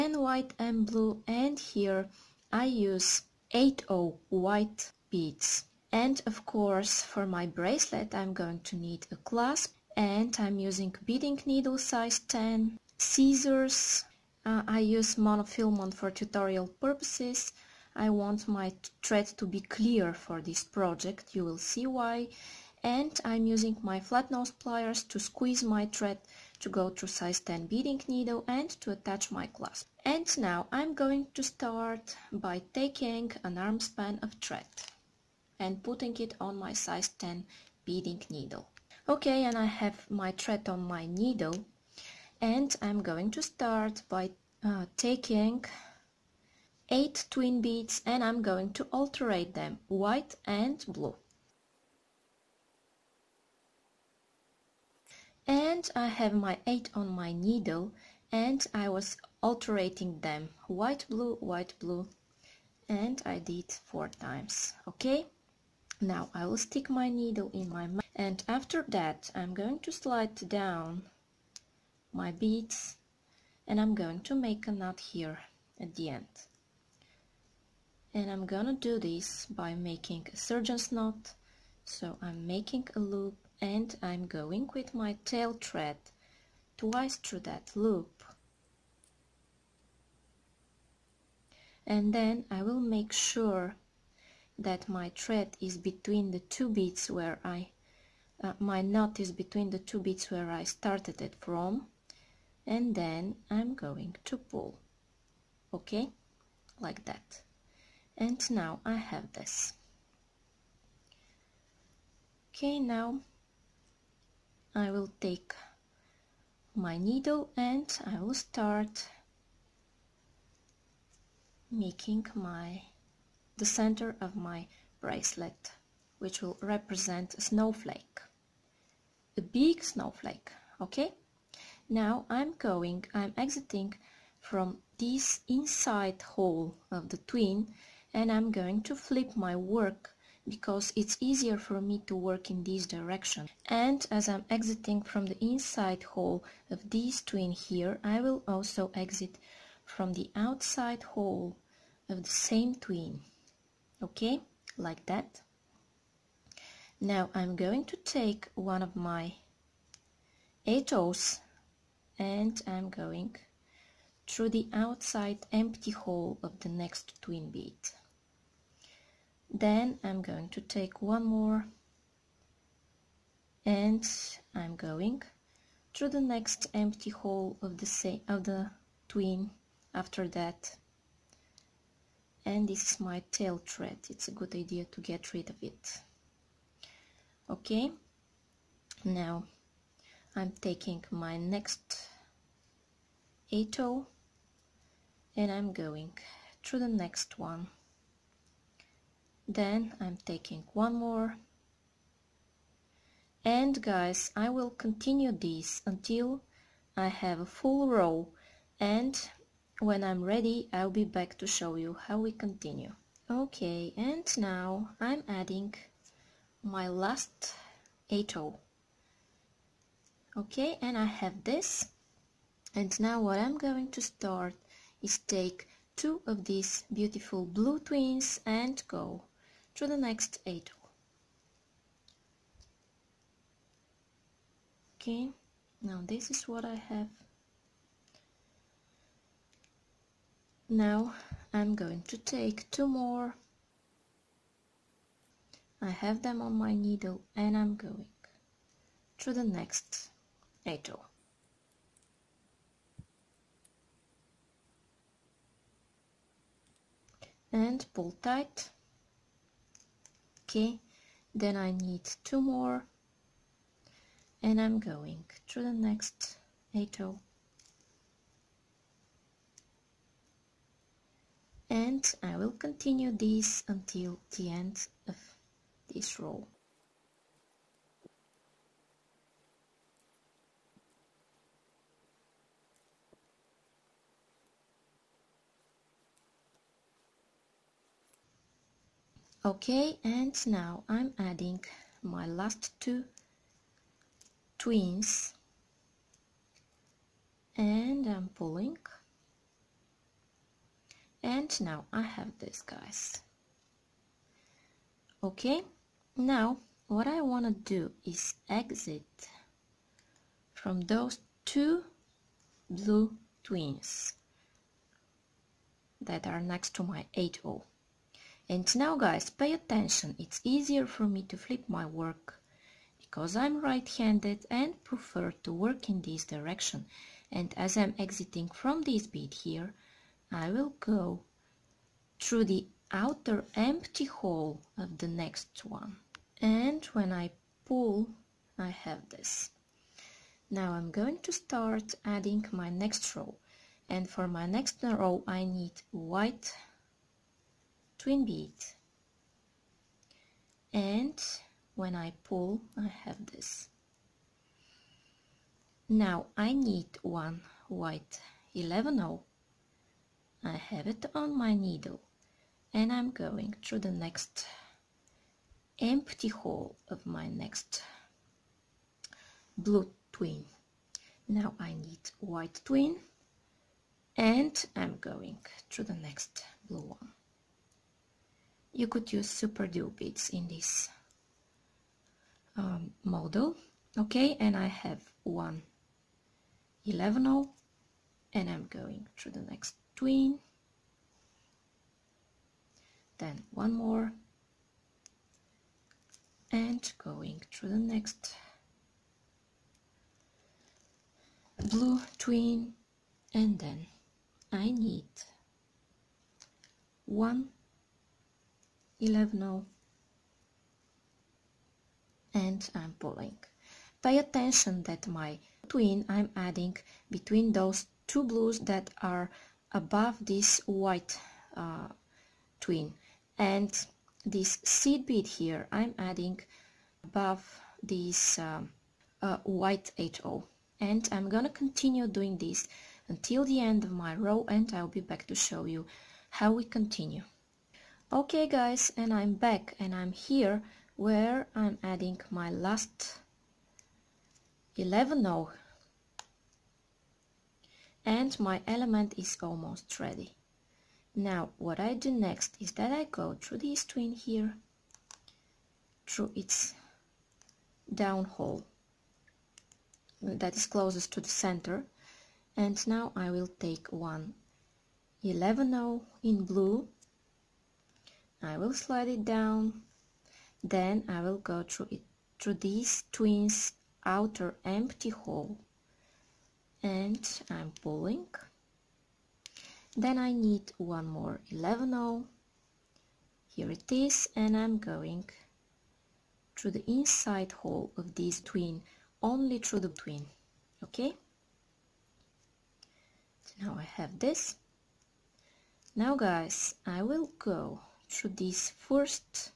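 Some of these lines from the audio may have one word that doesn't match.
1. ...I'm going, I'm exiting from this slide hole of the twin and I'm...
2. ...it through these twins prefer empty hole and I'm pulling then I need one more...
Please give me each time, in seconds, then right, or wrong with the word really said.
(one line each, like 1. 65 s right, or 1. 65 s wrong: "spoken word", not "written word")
1. 132 s wrong: "inside", not "slide"
2. 471 s wrong: "outer", not "prefer".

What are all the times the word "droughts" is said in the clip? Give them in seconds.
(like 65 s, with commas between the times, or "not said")
not said.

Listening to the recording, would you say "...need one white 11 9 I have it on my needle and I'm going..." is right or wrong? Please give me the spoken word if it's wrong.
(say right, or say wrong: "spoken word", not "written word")
wrong: "0", not "9".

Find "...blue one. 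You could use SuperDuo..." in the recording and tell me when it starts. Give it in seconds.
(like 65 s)
376 s.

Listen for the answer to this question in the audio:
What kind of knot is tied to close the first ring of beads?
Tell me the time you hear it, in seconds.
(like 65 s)
80 s.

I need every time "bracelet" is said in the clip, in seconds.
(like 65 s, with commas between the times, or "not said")
7 s, 124 s.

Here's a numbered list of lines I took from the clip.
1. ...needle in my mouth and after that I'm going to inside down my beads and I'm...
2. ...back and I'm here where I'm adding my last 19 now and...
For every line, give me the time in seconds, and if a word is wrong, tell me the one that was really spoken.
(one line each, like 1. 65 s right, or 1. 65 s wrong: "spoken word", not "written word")
1. 67 s wrong: "slide", not "inside"
2. 439 s wrong: "11", not "19".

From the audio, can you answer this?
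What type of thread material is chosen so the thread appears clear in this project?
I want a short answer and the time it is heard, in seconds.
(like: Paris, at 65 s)
monofilament, at 15 s.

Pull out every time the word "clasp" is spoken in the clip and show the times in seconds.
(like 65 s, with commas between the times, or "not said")
9 s, 29 s.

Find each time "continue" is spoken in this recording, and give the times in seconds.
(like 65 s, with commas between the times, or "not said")
204 s, 212 s, 272 s, 431 s, 436 s.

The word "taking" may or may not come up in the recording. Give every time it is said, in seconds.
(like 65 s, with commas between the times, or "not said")
32 s, 44 s, 190 s, 200 s.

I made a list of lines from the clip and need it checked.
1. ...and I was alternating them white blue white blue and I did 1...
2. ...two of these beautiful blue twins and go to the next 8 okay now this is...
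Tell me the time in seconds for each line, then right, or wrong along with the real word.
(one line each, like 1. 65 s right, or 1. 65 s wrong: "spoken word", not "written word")
1. 58 s wrong: "4", not "1"
2. 225 s right.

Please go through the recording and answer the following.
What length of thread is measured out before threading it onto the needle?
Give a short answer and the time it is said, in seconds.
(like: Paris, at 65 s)
an arm span, at 33 s.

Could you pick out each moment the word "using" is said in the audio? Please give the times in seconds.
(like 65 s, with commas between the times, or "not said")
10 s, 23 s.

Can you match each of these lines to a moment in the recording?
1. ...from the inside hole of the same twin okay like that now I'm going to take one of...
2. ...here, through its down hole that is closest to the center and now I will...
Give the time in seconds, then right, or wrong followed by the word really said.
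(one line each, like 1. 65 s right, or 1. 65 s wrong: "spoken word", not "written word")
1. 149 s wrong: "outside", not "inside"
2. 454 s right.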